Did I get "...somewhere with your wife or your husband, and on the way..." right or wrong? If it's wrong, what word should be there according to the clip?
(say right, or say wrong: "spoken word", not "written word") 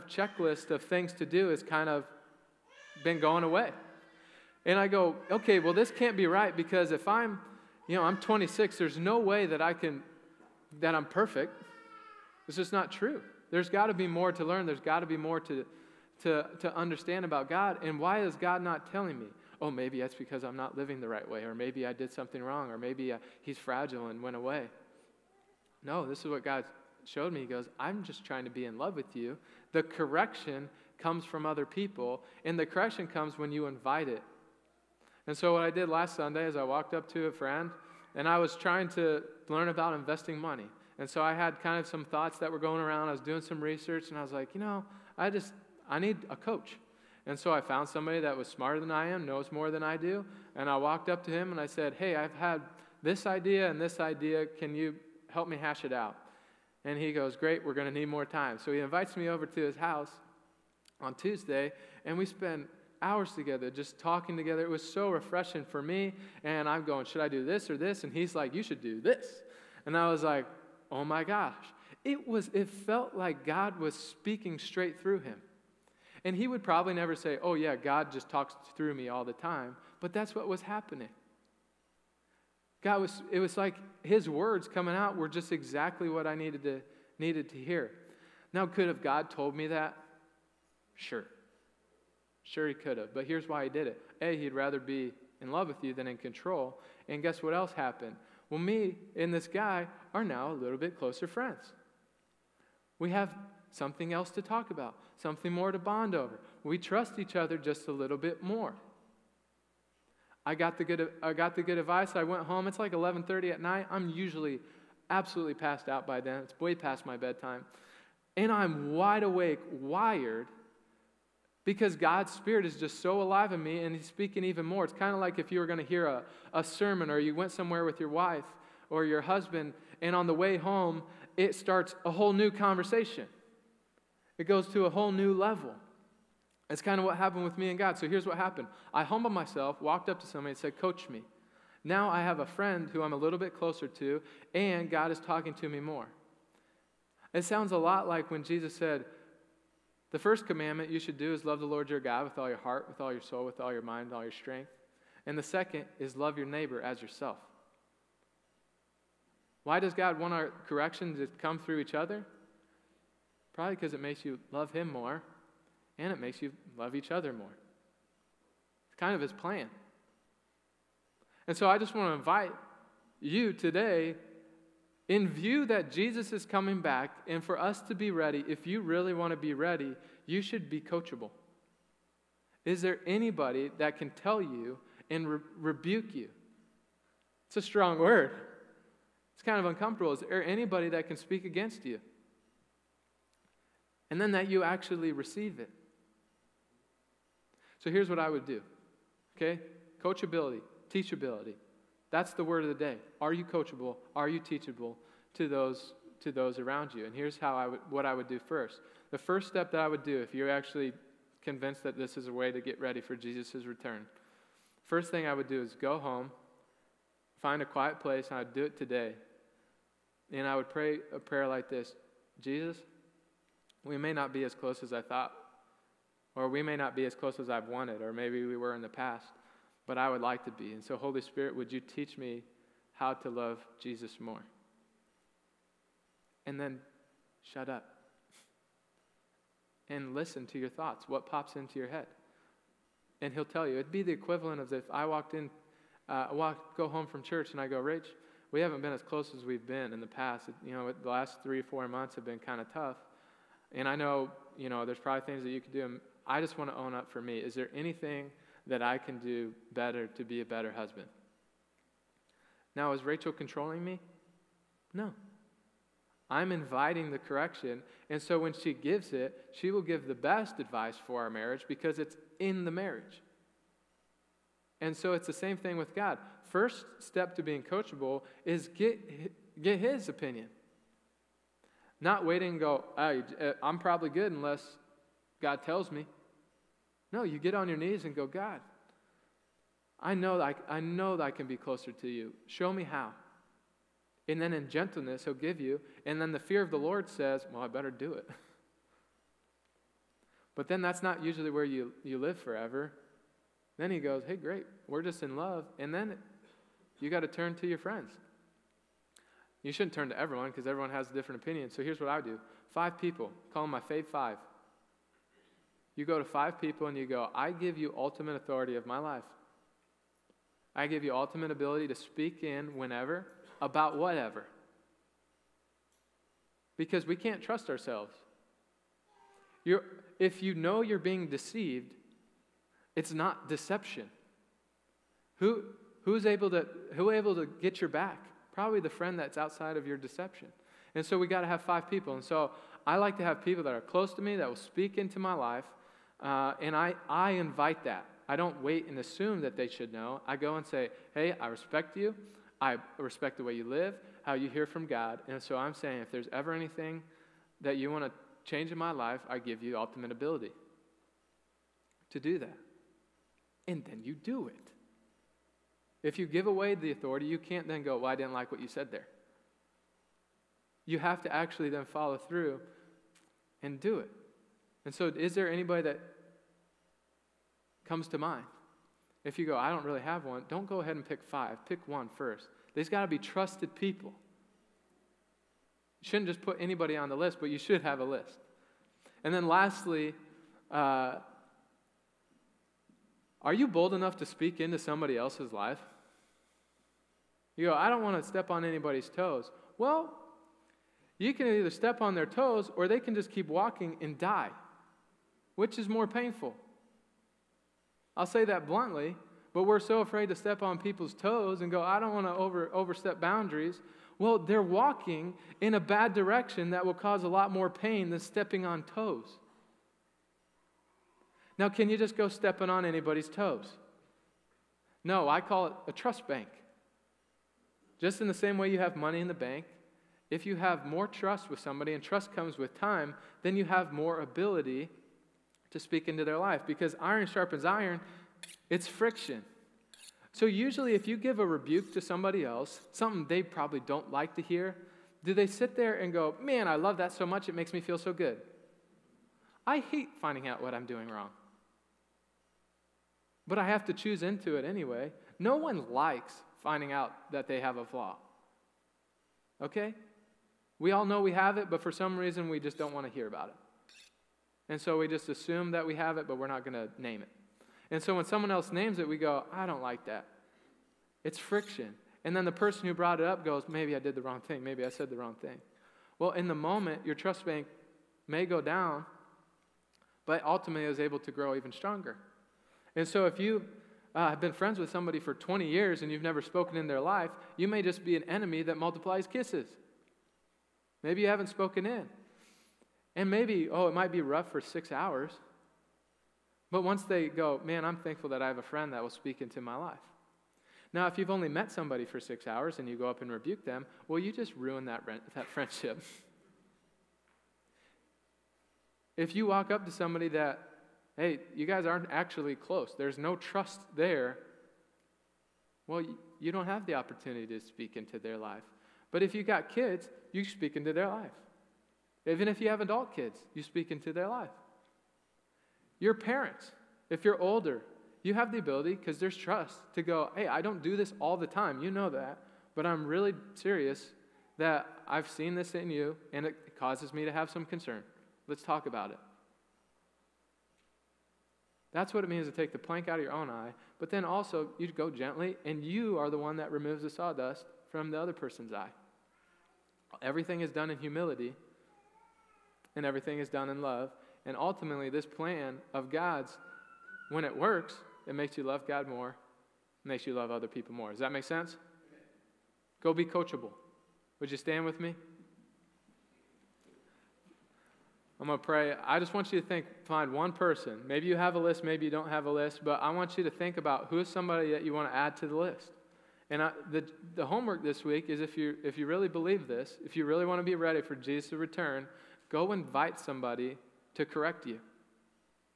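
right.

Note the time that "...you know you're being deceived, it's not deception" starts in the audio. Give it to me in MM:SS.
05:30.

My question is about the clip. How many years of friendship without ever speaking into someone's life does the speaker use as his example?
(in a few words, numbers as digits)
20.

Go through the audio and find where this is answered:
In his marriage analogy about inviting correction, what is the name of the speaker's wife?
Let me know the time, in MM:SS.
04:23.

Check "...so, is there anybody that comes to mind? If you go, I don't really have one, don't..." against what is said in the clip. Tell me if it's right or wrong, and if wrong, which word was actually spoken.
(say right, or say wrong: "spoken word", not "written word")
right.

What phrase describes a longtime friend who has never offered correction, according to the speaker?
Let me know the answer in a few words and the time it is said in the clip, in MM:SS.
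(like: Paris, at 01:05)
an enemy that multiplies kisses, at 08:08.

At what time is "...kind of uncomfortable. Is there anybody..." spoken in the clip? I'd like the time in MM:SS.
03:09.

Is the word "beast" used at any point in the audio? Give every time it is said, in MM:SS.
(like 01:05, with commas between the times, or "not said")
not said.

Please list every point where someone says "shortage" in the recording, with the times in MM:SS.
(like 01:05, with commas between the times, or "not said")
not said.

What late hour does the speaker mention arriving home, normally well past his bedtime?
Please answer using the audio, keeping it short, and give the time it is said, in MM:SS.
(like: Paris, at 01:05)
11:30, at 01:52.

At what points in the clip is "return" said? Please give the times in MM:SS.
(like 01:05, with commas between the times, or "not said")
03:33, 09:41.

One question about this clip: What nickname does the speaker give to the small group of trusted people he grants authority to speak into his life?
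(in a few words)
fave five.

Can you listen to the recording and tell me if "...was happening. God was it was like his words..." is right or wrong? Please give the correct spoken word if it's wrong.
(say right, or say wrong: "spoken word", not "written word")
right.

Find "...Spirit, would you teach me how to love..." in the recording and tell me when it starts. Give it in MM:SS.
03:51.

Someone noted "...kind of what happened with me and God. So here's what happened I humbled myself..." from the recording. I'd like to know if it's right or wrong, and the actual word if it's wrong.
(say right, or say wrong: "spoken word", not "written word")
right.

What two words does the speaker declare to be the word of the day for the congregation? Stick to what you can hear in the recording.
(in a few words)
Coachability, teachability.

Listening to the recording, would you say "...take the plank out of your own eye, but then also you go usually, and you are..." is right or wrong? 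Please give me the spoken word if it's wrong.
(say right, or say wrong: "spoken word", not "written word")
wrong: "gently", not "usually".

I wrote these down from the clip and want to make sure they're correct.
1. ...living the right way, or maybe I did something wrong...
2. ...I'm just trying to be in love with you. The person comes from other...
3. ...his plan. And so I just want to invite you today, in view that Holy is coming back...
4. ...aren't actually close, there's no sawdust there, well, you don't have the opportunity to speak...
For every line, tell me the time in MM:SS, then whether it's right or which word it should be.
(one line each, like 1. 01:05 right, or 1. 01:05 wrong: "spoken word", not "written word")
1. 00:20 right
2. 00:27 wrong: "correction", not "person"
3. 02:49 wrong: "Jesus", not "Holy"
4. 08:31 wrong: "trust", not "sawdust".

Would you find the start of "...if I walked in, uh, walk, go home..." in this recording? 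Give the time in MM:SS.
04:04.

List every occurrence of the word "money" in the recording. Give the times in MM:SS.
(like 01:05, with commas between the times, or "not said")
00:40, 07:08.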